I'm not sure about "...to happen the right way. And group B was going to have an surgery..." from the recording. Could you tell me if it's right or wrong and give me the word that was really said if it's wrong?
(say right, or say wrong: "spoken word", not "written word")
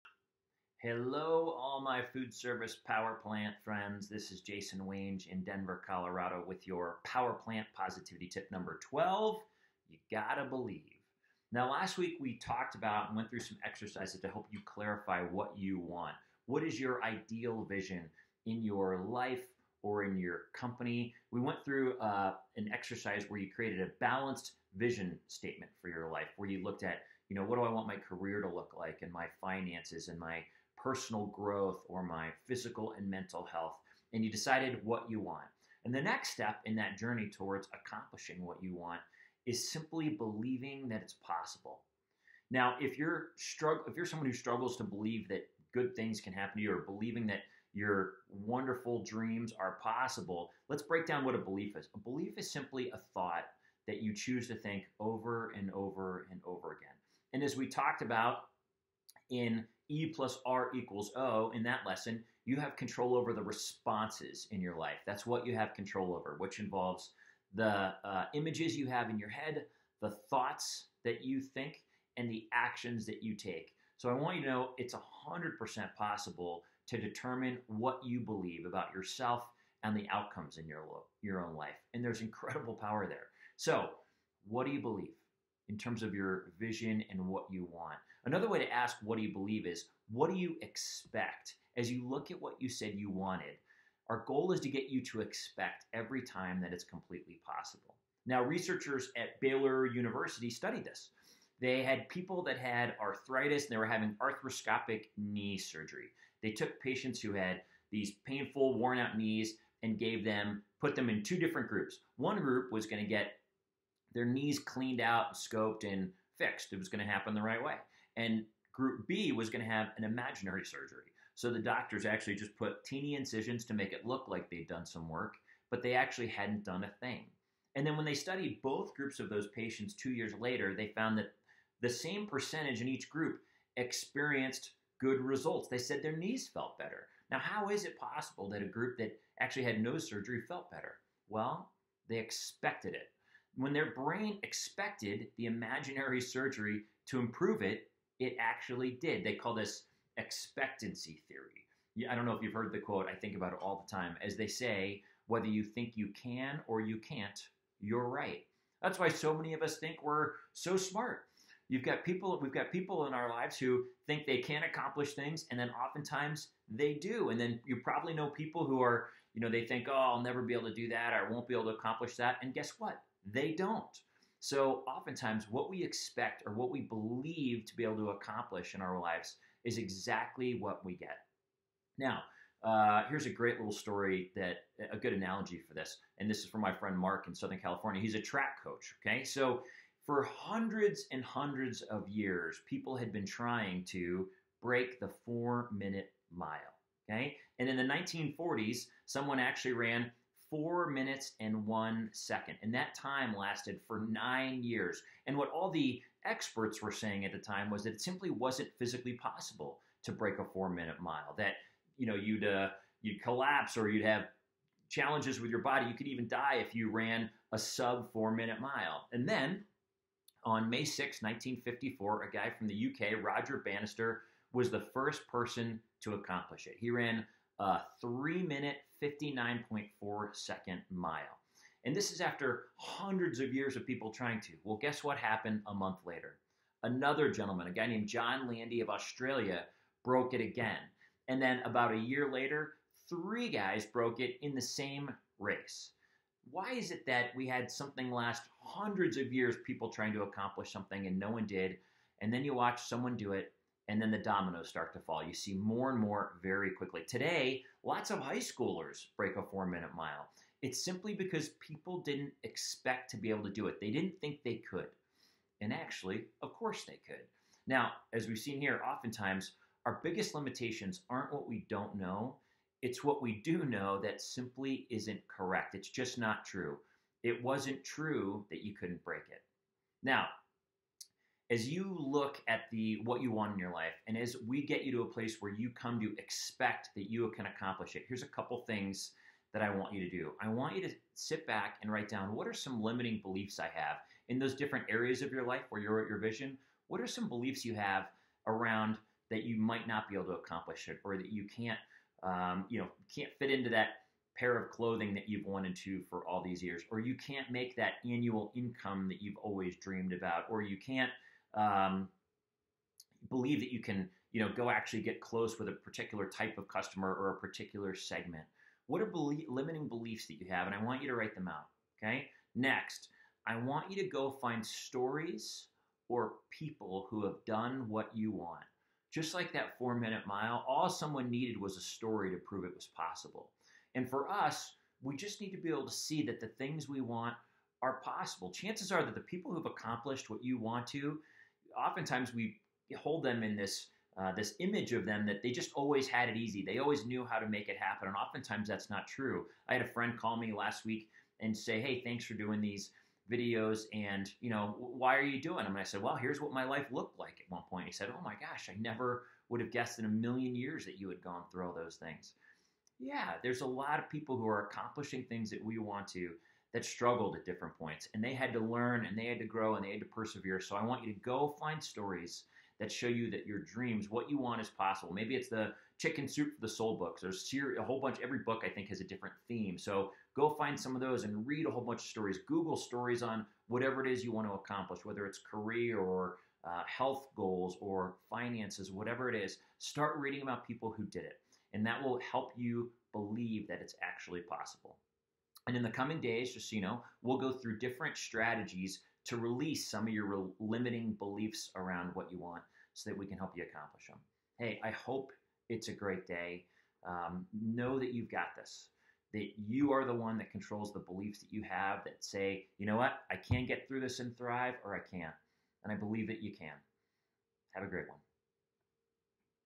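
wrong: "imaginary", not "surgery".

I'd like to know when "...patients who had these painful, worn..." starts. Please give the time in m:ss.
1:46.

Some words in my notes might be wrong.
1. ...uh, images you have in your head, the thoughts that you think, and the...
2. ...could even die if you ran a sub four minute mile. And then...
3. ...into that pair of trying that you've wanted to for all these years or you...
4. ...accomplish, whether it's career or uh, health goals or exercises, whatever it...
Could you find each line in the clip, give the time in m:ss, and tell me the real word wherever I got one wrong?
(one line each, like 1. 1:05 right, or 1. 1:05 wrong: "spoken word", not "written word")
1. 1:08 right
2. 3:35 right
3. 5:03 wrong: "clothing", not "trying"
4. 6:24 wrong: "finances", not "exercises".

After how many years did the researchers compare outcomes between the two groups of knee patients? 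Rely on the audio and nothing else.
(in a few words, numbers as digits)
2 years.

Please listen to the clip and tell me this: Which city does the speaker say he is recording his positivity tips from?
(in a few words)
Denver.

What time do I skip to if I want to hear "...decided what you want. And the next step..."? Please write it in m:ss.
0:34.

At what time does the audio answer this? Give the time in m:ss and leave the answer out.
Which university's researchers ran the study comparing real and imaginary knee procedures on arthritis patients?
1:39.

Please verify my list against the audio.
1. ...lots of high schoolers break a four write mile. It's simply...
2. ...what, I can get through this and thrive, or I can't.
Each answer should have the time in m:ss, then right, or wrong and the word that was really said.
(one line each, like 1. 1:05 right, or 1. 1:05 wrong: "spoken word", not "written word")
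1. 4:17 wrong: "minute", not "write"
2. 6:52 right.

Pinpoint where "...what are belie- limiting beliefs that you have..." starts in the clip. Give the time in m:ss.
5:18.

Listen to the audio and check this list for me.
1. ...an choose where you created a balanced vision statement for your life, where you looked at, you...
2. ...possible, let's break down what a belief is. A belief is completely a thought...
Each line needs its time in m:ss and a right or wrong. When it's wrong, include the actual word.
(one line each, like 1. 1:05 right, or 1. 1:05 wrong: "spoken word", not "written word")
1. 0:22 wrong: "exercise", not "choose"
2. 0:49 wrong: "simply", not "completely".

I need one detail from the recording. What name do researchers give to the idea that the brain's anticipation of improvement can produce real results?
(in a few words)
expectancy theory.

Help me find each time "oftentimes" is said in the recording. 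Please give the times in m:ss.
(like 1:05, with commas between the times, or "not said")
2:45, 2:54, 4:28, 5:41, 5:48.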